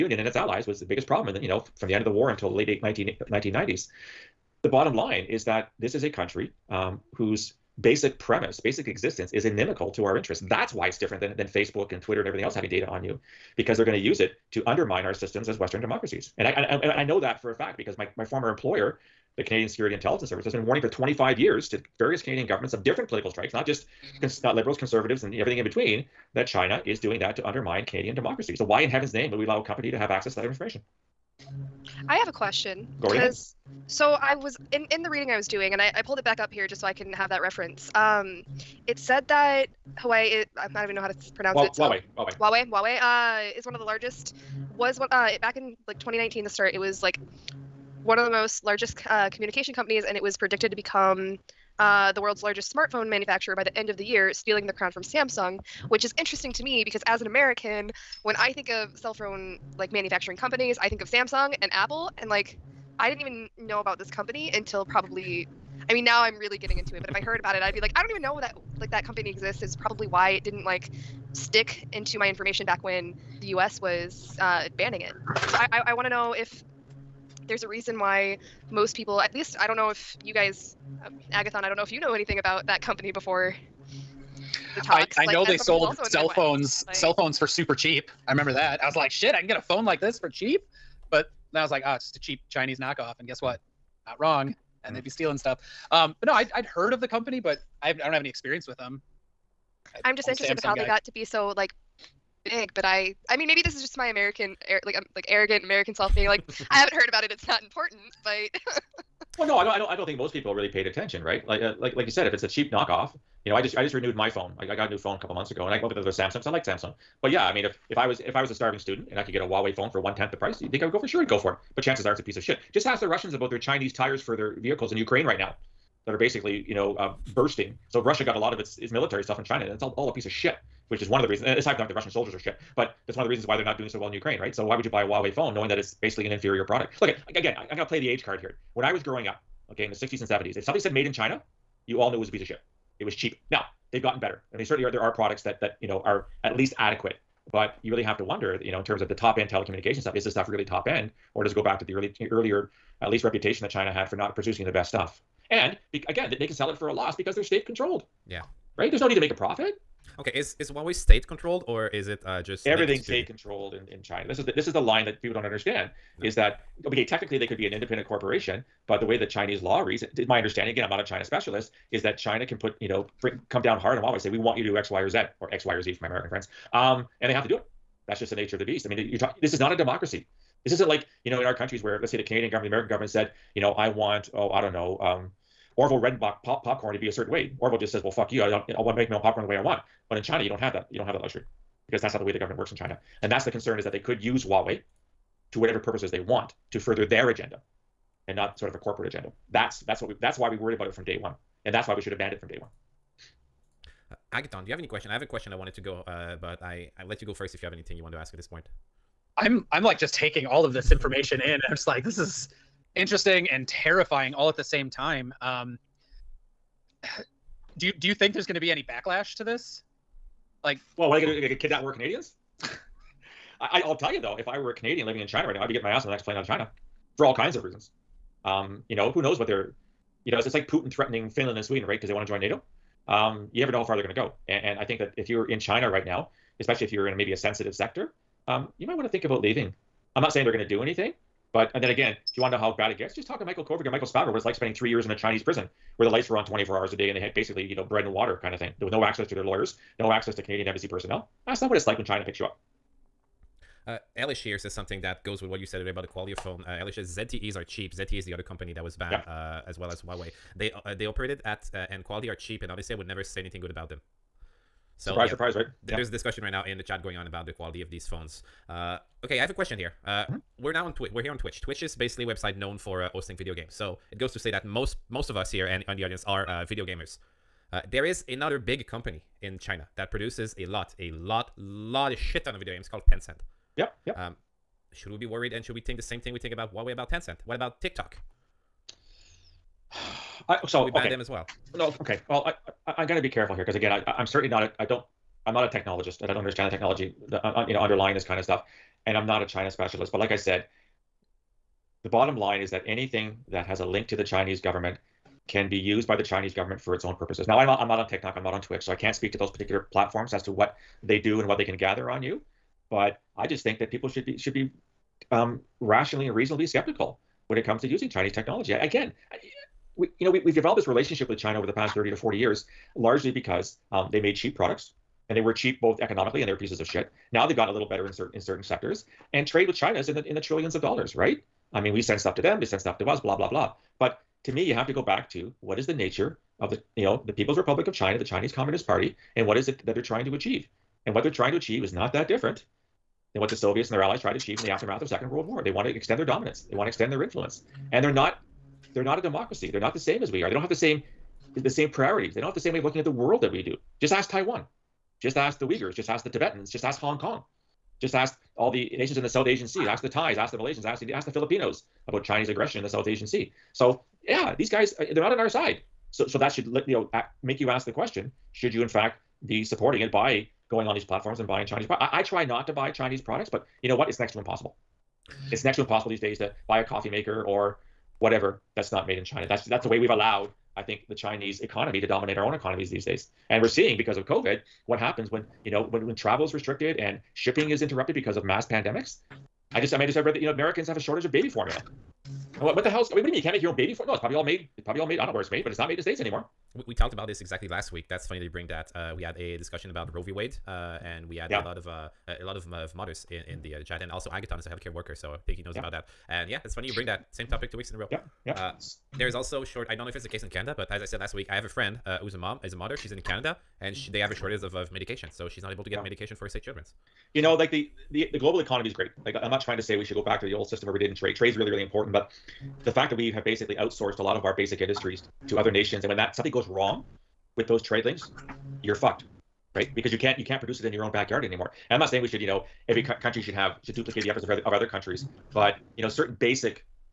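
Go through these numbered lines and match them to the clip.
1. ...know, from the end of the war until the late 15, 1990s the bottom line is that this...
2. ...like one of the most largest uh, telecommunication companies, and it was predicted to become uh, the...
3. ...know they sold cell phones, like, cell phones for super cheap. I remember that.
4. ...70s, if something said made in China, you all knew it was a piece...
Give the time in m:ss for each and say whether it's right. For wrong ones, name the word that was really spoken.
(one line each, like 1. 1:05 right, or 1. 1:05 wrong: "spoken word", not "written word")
1. 0:01 wrong: "19", not "15"
2. 0:47 wrong: "communication", not "telecommunication"
3. 1:25 right
4. 2:20 right.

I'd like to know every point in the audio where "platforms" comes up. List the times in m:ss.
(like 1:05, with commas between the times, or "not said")
5:09, 6:11.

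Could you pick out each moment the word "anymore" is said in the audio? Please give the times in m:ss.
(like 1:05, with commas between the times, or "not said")
6:36, 7:11.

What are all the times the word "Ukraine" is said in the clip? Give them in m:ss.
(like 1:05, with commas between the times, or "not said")
2:04, 2:14.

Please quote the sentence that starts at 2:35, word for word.
And be, again, they can sell it for a loss because they're state controlled.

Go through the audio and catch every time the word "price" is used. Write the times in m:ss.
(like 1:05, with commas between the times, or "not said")
2:00.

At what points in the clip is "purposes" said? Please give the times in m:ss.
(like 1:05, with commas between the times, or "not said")
3:15, 5:07.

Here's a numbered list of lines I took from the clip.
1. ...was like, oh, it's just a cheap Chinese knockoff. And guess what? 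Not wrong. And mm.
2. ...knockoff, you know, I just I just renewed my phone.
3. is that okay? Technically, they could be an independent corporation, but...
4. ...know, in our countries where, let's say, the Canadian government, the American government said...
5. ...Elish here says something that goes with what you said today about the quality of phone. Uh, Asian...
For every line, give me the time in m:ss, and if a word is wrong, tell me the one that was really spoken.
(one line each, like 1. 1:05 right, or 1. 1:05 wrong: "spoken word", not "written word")
1. 1:31 right
2. 1:52 right
3. 2:46 right
4. 3:01 right
5. 4:14 wrong: "Elish", not "Asian".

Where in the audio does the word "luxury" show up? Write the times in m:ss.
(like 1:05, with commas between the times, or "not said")
3:11.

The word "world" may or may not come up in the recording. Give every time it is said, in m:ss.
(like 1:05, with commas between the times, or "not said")
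0:52, 5:45, 5:53.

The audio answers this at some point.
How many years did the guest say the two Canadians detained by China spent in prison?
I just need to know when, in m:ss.
4:04.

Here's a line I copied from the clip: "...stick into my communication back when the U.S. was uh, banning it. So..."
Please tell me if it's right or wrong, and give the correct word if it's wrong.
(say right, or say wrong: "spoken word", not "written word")
wrong: "information", not "communication".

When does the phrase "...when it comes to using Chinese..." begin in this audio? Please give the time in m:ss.
5:17.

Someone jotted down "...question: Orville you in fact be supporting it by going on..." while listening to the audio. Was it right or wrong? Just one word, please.
wrong.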